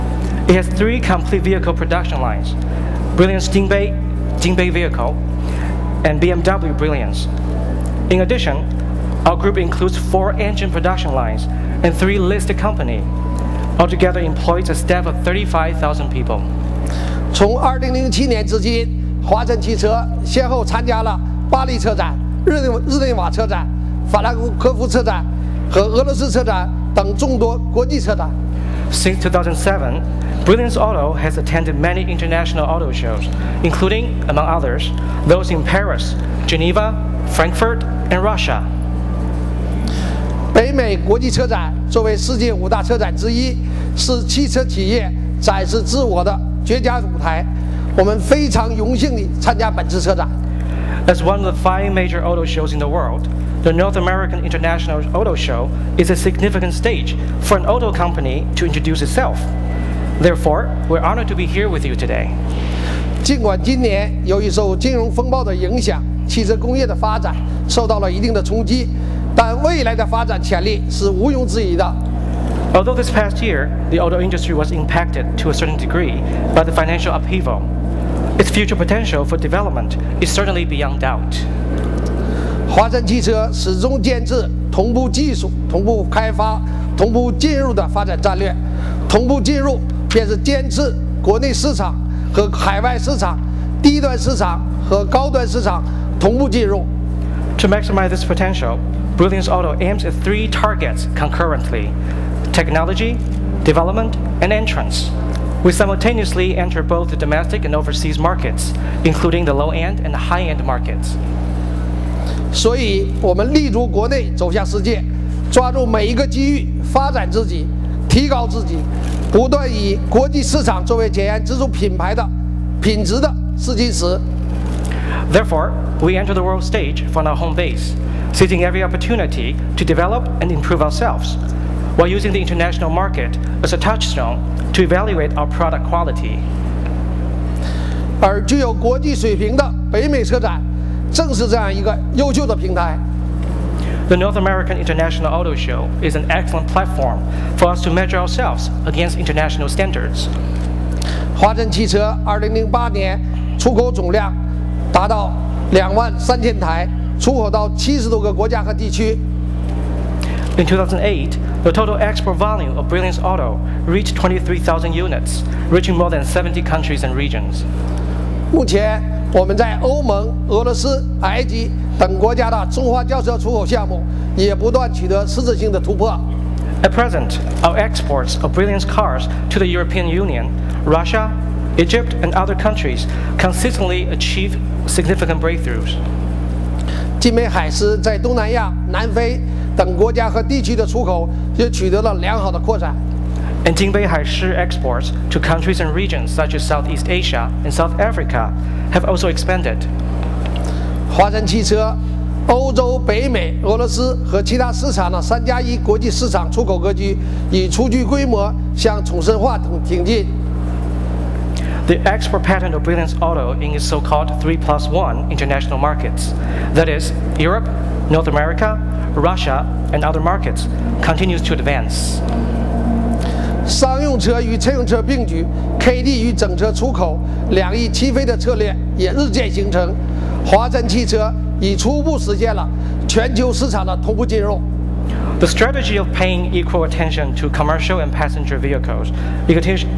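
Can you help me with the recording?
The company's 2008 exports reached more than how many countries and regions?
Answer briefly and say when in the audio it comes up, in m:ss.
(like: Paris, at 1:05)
70, at 2:45.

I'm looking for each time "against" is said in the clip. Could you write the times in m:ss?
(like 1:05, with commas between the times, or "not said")
2:28.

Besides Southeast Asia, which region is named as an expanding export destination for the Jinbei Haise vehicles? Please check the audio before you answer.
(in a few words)
South Africa.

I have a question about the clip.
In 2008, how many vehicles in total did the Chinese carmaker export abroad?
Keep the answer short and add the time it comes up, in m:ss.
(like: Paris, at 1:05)
23,000 units, at 2:44.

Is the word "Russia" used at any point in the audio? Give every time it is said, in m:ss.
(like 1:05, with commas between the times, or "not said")
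0:38, 3:00, 3:39.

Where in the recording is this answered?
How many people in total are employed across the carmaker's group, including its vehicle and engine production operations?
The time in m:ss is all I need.
0:15.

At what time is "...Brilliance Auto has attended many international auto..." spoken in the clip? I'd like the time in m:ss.
0:30.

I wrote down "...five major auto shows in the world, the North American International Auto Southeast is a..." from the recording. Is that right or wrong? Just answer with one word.
wrong.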